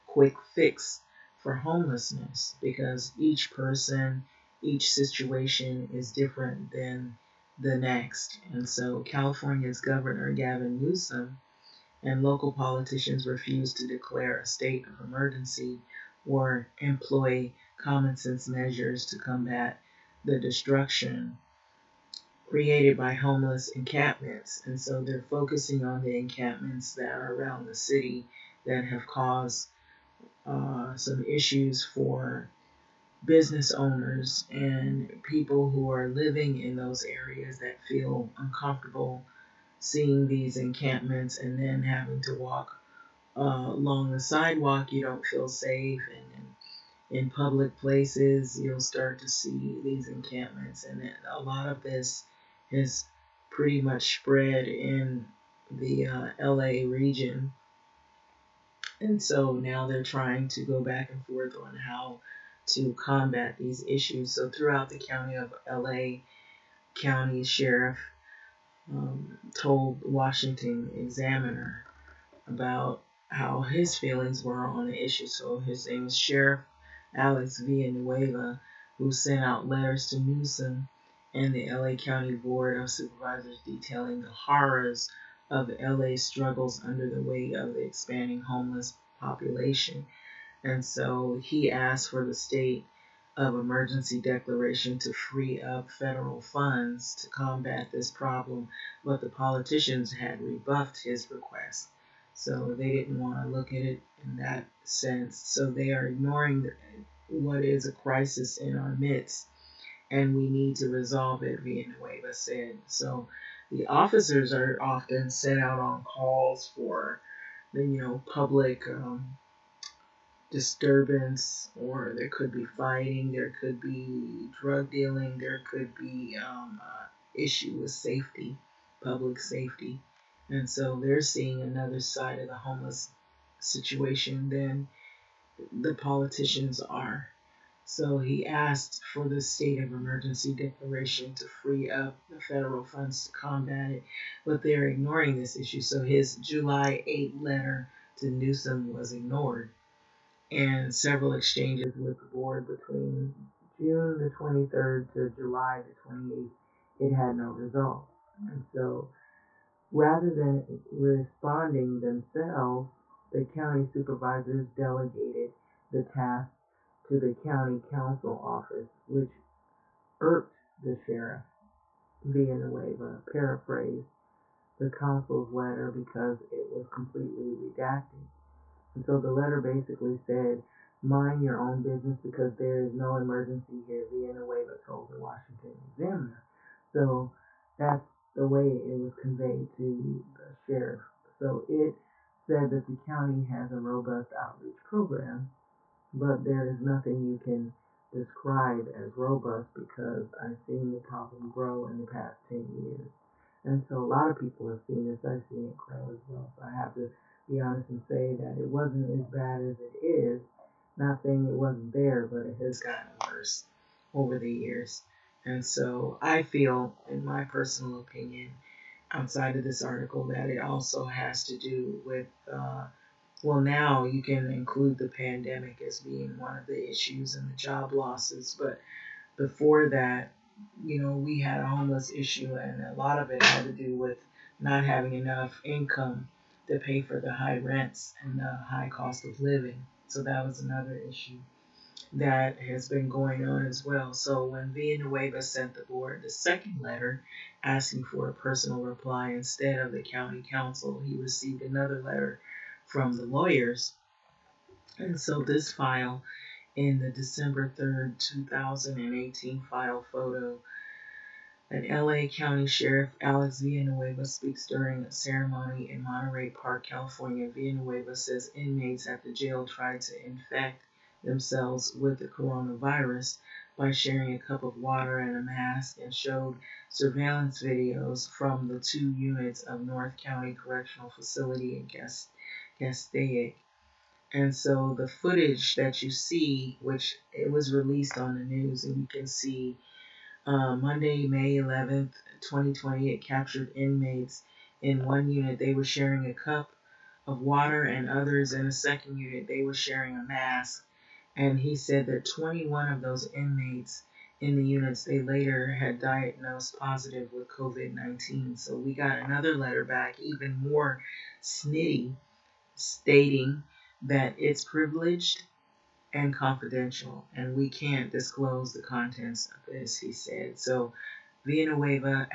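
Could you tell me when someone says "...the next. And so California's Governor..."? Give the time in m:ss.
0:07.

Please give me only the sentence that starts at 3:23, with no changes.
And so a lot of people have seen this.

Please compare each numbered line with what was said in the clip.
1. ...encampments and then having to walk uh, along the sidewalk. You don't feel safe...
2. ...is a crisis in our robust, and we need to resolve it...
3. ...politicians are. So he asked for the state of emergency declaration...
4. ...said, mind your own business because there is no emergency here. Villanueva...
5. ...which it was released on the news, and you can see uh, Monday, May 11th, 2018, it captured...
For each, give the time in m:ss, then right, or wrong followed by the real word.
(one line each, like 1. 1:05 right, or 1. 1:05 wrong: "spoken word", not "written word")
1. 0:40 right
2. 1:47 wrong: "midst", not "robust"
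3. 2:15 right
4. 3:00 right
5. 4:46 wrong: "2020", not "2018".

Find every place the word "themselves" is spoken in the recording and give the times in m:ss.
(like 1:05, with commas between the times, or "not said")
2:42, 4:31.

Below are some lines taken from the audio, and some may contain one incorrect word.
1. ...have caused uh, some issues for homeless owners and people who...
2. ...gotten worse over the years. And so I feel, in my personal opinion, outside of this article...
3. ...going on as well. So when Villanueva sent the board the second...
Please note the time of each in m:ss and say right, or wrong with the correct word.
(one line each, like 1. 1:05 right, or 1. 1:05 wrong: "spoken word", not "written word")
1. 0:28 wrong: "business", not "homeless"
2. 3:32 right
3. 4:03 right.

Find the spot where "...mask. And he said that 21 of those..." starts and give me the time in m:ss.
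5:00.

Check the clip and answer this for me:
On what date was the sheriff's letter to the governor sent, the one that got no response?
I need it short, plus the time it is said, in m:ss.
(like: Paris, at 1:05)
July 8, at 2:26.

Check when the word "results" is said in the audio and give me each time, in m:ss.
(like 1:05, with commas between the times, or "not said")
2:37.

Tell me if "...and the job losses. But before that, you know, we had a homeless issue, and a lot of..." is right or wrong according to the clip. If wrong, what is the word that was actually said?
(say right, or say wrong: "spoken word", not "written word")
right.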